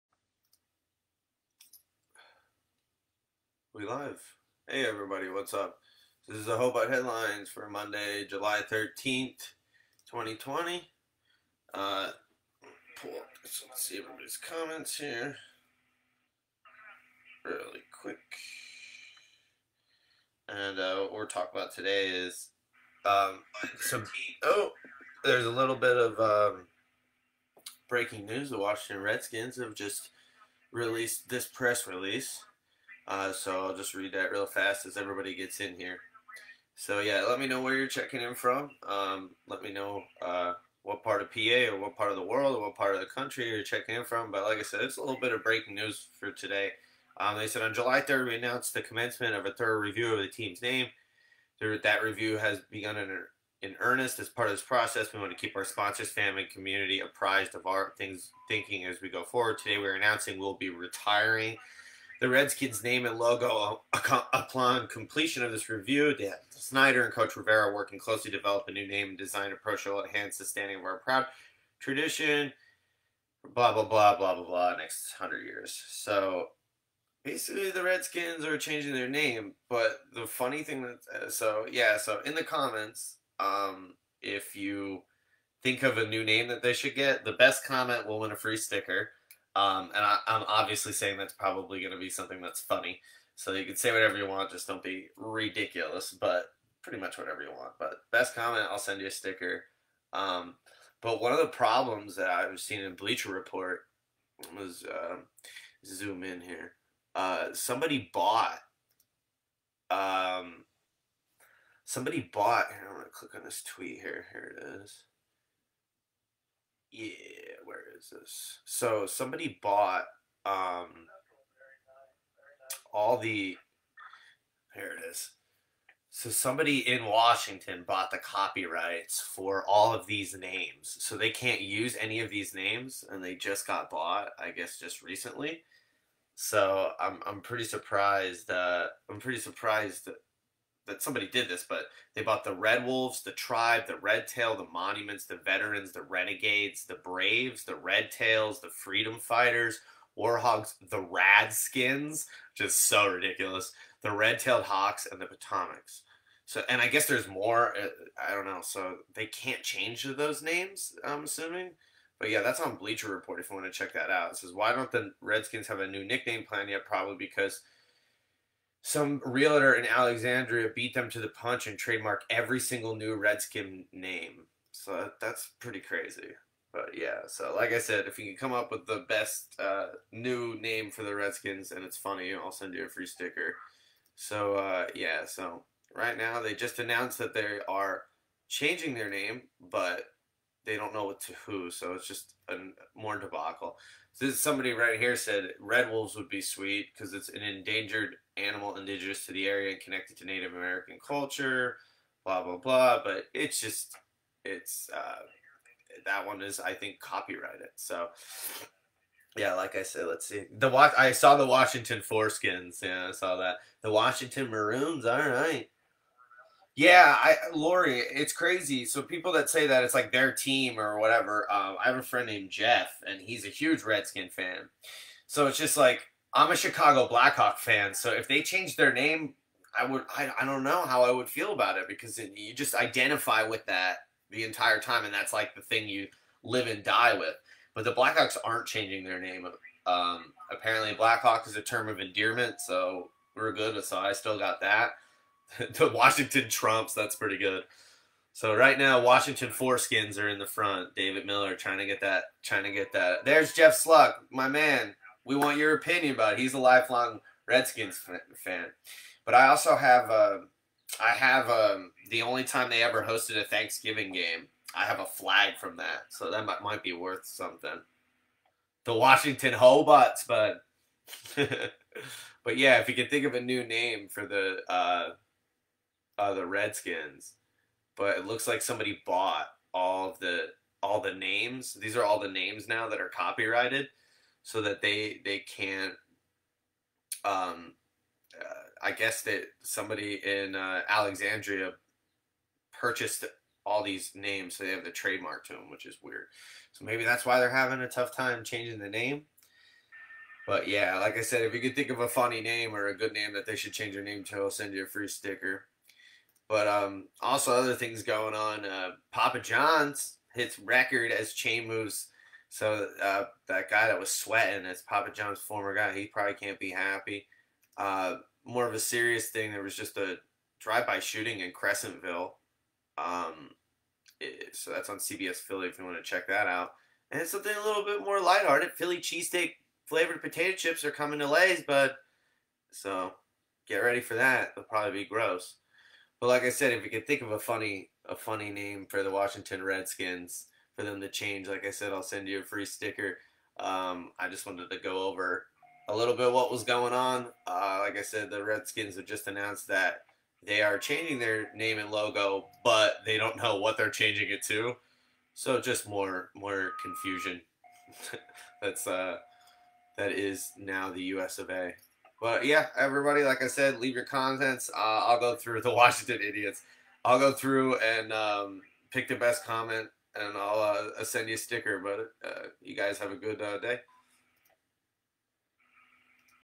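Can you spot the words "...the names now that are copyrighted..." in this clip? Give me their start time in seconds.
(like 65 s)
282 s.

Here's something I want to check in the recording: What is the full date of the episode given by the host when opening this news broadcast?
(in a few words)
Monday, July 13th, 2020.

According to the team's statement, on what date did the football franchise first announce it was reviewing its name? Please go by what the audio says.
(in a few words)
July 3rd.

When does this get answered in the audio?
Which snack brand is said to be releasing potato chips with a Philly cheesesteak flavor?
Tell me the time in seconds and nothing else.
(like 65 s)
331 s.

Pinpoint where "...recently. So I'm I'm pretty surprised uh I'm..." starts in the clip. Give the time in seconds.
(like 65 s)
135 s.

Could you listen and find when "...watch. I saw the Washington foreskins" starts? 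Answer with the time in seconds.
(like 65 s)
210 s.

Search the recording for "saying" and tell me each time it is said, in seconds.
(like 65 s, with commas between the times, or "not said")
90 s.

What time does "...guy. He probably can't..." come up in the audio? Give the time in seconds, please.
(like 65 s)
315 s.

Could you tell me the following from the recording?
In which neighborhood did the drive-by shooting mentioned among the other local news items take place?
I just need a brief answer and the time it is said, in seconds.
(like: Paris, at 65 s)
Crescentville, at 321 s.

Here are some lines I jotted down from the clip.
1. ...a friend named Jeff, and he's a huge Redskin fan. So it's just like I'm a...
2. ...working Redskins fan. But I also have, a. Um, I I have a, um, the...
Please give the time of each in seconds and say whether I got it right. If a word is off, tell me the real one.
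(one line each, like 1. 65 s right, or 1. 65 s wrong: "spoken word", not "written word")
1. 221 s right
2. 256 s wrong: "lifelong", not "working".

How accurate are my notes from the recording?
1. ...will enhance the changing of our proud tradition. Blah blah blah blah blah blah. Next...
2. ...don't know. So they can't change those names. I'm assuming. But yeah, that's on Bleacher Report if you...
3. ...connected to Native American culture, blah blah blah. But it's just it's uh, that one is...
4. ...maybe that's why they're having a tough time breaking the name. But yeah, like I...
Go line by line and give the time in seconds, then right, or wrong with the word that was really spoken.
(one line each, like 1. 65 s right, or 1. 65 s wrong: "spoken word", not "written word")
1. 69 s wrong: "standing", not "changing"
2. 158 s right
3. 199 s right
4. 296 s wrong: "changing", not "breaking".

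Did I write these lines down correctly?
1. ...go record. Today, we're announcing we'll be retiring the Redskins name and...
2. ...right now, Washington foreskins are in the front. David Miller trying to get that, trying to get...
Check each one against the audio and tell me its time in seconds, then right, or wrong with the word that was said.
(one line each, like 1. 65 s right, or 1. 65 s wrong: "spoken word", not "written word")
1. 59 s wrong: "forward", not "record"
2. 248 s right.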